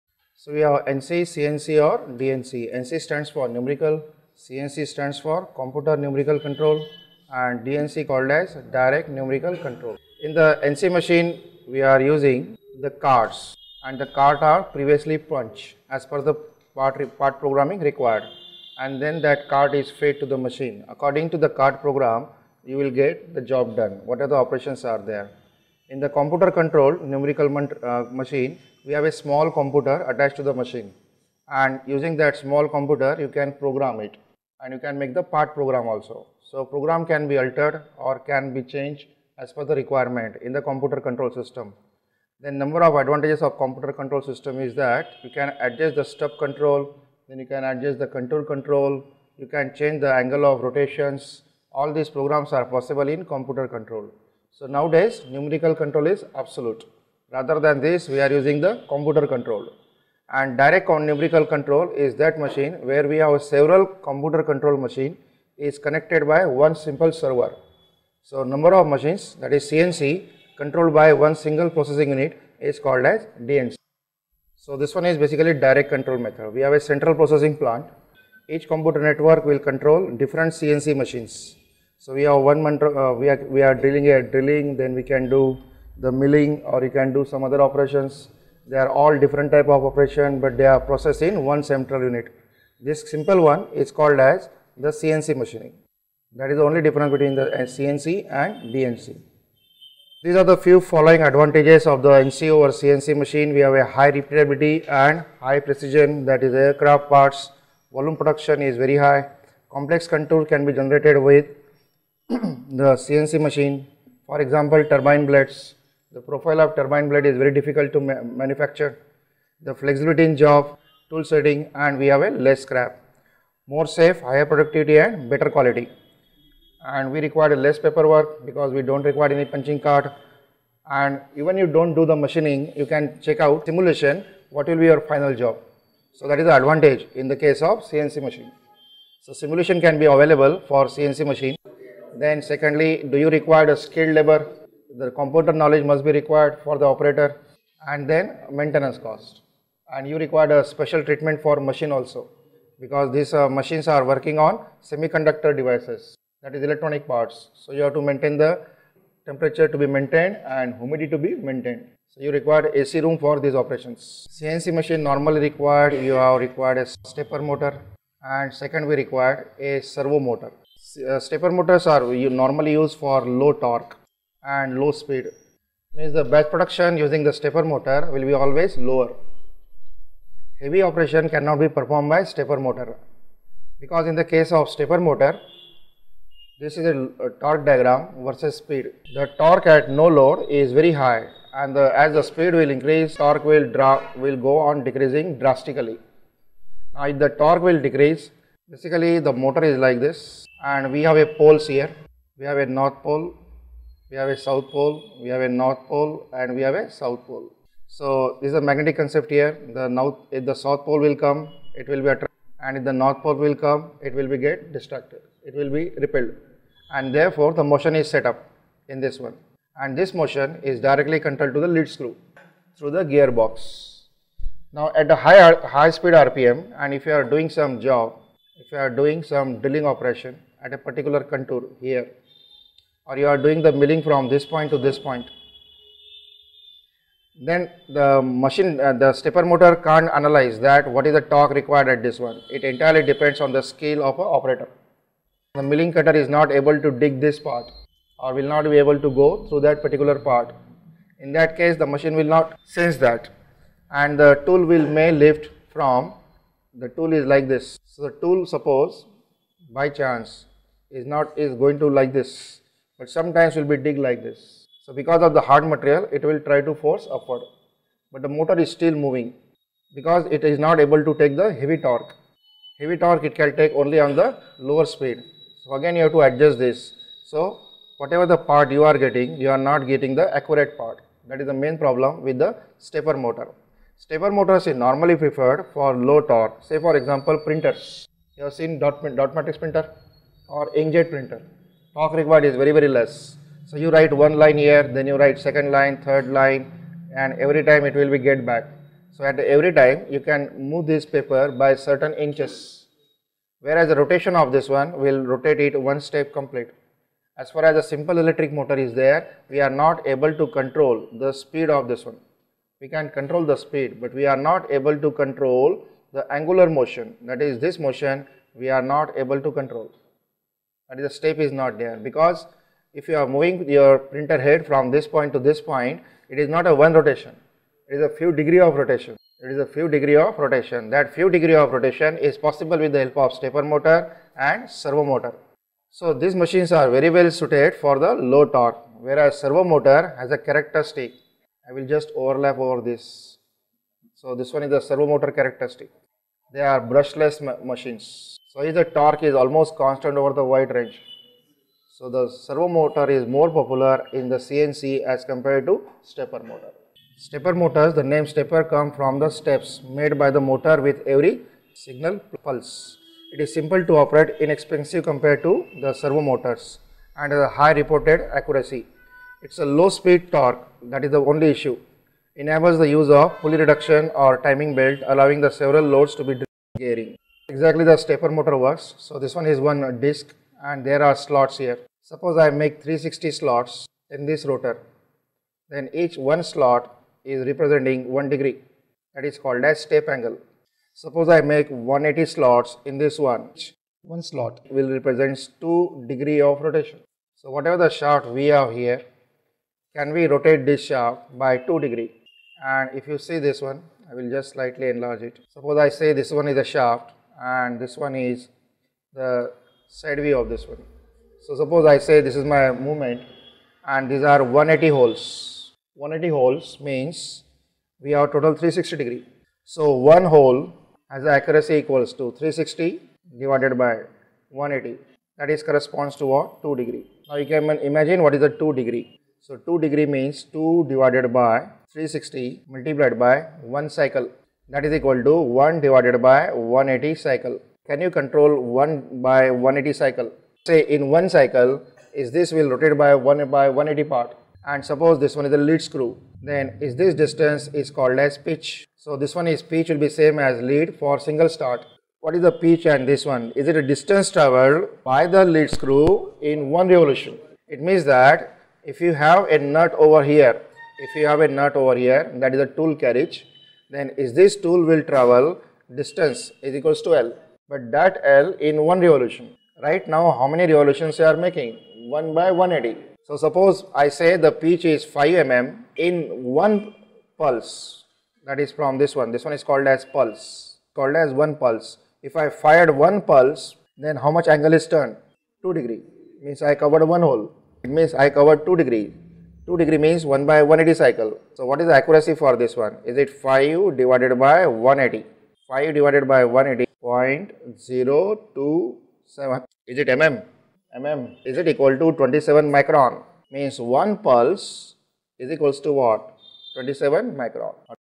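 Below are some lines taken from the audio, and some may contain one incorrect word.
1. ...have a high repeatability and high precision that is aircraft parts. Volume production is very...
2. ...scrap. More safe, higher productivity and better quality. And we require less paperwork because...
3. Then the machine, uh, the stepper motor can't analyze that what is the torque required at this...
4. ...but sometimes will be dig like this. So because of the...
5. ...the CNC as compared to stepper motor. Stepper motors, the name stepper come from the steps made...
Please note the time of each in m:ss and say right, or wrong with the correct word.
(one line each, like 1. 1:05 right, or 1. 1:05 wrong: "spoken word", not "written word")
1. 1:43 right
2. 2:02 right
3. 3:57 right
4. 4:23 right
5. 5:54 right.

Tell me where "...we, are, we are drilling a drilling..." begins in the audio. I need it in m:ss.
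1:23.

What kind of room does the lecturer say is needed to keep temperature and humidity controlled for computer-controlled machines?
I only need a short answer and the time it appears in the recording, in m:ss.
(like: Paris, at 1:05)
AC room, at 2:42.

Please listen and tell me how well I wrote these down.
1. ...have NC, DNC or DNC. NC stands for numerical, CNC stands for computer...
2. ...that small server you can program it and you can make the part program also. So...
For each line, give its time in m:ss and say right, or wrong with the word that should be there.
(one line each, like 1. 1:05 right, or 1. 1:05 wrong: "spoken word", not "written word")
1. 0:00 wrong: "CNC", not "DNC"
2. 0:32 wrong: "computer", not "server".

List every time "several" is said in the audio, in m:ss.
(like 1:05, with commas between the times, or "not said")
1:03, 6:15.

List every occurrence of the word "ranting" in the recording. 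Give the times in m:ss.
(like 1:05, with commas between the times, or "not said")
not said.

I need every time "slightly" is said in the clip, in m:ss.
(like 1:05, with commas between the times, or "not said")
6:44.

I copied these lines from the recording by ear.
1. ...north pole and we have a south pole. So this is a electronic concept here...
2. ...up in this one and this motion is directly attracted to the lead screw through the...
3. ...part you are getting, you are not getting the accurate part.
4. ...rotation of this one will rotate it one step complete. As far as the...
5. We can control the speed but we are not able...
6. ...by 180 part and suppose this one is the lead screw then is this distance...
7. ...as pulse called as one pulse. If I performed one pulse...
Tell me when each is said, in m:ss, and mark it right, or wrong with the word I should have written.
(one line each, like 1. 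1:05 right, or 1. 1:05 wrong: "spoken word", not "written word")
1. 3:25 wrong: "magnetic", not "electronic"
2. 3:38 wrong: "controlled", not "attracted"
3. 4:38 right
4. 5:03 right
5. 5:12 right
6. 7:23 right
7. 7:59 wrong: "fired", not "performed".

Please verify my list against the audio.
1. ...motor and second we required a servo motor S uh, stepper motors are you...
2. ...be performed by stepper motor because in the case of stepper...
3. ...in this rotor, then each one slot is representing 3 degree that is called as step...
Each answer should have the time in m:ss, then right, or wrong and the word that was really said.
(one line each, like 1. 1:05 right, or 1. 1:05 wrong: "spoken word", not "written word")
1. 2:47 right
2. 3:01 right
3. 6:24 wrong: "1", not "3".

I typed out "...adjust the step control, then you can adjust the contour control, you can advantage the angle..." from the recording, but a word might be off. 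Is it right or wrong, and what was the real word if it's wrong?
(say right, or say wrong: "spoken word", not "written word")
wrong: "change", not "advantage".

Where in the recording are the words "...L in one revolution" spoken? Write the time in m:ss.
7:48.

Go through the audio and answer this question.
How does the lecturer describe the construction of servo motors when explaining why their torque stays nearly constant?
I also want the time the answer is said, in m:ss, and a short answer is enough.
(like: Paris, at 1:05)
Brushless, at 5:46.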